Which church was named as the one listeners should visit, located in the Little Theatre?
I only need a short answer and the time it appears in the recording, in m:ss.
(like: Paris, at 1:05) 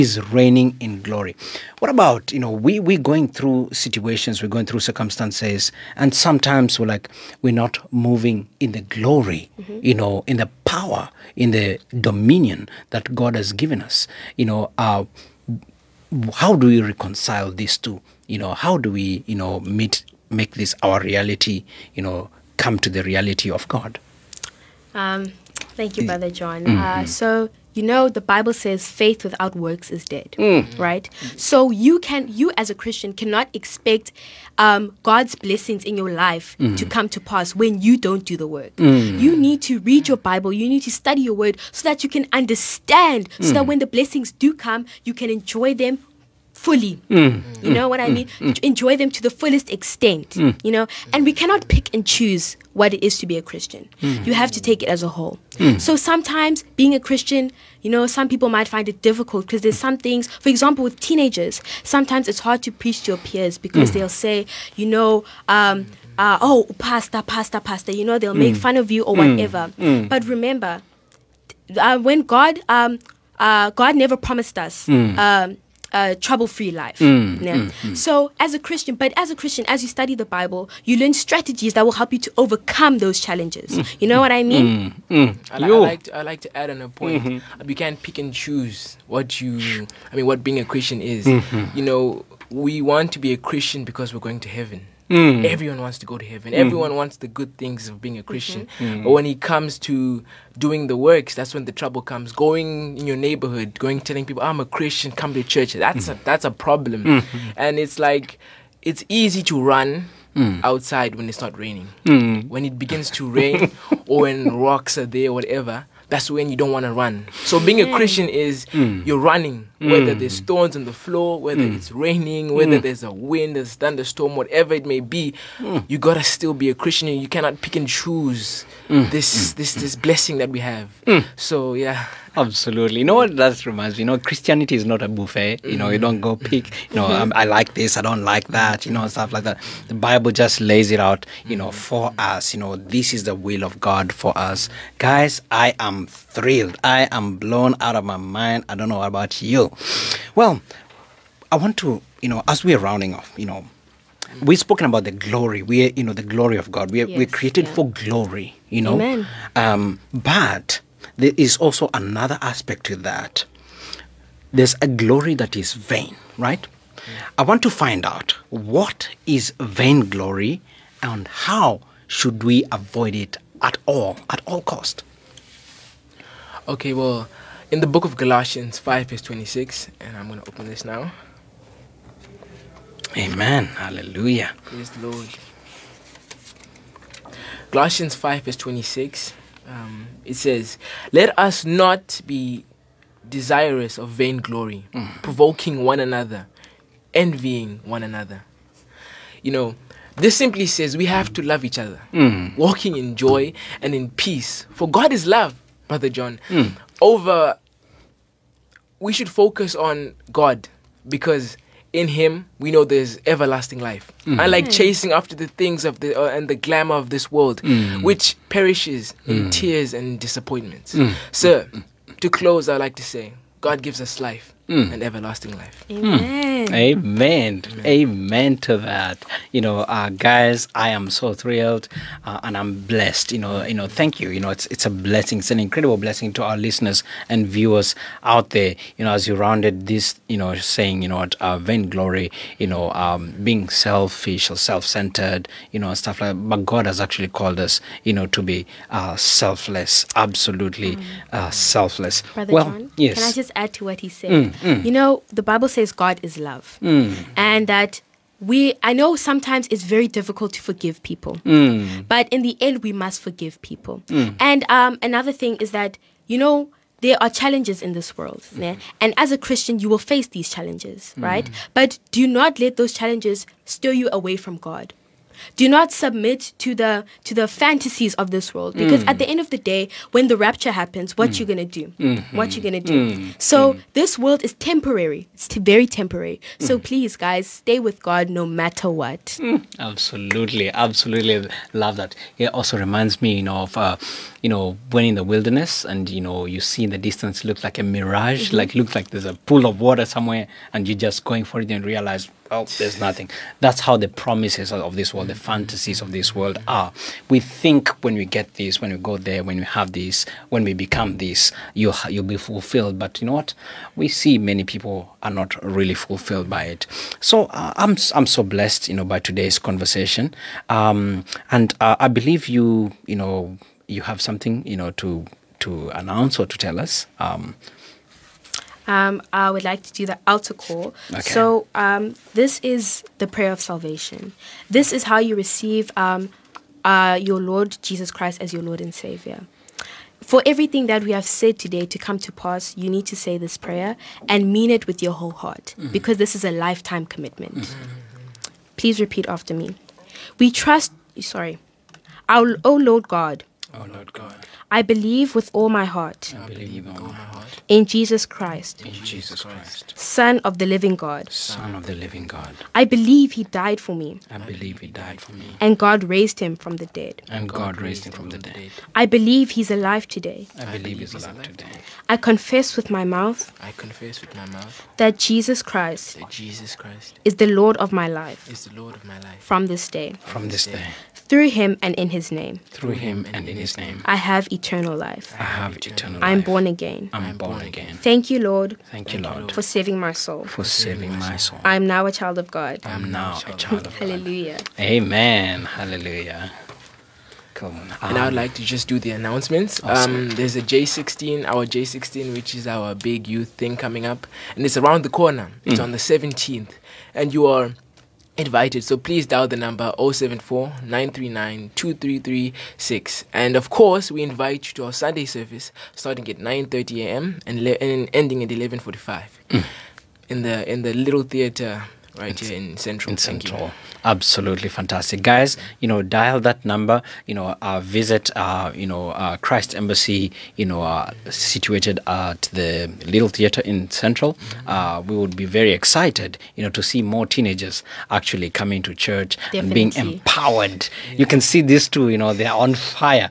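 Christ Embassy, at 7:09.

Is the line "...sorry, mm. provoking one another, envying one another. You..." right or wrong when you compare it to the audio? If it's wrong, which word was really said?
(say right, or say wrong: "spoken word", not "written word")
wrong: "vainglory", not "sorry".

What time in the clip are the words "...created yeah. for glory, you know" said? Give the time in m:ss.
2:37.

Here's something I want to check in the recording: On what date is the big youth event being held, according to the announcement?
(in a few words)
17th.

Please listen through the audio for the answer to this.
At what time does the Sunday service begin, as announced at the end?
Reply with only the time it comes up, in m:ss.
6:56.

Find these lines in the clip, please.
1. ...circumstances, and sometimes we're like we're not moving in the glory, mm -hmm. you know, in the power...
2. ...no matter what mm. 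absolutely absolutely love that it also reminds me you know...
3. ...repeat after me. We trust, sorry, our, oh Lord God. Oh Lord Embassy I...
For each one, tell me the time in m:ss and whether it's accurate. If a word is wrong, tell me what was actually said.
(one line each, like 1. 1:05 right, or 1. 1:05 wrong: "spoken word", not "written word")
1. 0:04 right
2. 4:48 right
3. 5:48 wrong: "God", not "Embassy".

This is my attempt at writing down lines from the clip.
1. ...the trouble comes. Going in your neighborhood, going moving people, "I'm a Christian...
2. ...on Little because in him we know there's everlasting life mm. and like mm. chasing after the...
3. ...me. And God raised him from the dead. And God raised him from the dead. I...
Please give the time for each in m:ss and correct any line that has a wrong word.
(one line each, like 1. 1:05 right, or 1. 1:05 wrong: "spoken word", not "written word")
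1. 1:41 wrong: "telling", not "moving"
2. 3:29 wrong: "God", not "Little"
3. 6:05 right.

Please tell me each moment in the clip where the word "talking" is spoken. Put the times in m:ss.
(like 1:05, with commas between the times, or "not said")
not said.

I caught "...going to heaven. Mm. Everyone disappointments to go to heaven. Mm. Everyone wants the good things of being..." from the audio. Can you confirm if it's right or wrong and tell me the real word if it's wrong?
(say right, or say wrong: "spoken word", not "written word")
wrong: "wants", not "disappointments".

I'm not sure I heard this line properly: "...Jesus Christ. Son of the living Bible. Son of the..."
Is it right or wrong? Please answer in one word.
wrong.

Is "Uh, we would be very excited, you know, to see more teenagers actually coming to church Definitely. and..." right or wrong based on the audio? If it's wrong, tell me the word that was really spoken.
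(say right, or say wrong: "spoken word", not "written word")
right.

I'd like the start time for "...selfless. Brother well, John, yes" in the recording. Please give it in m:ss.
4:11.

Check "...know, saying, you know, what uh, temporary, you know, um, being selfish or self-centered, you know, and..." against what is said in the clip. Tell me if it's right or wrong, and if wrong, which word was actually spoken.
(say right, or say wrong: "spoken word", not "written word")
wrong: "vainglory", not "temporary".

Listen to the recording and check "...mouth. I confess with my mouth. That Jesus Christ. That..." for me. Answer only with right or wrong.
right.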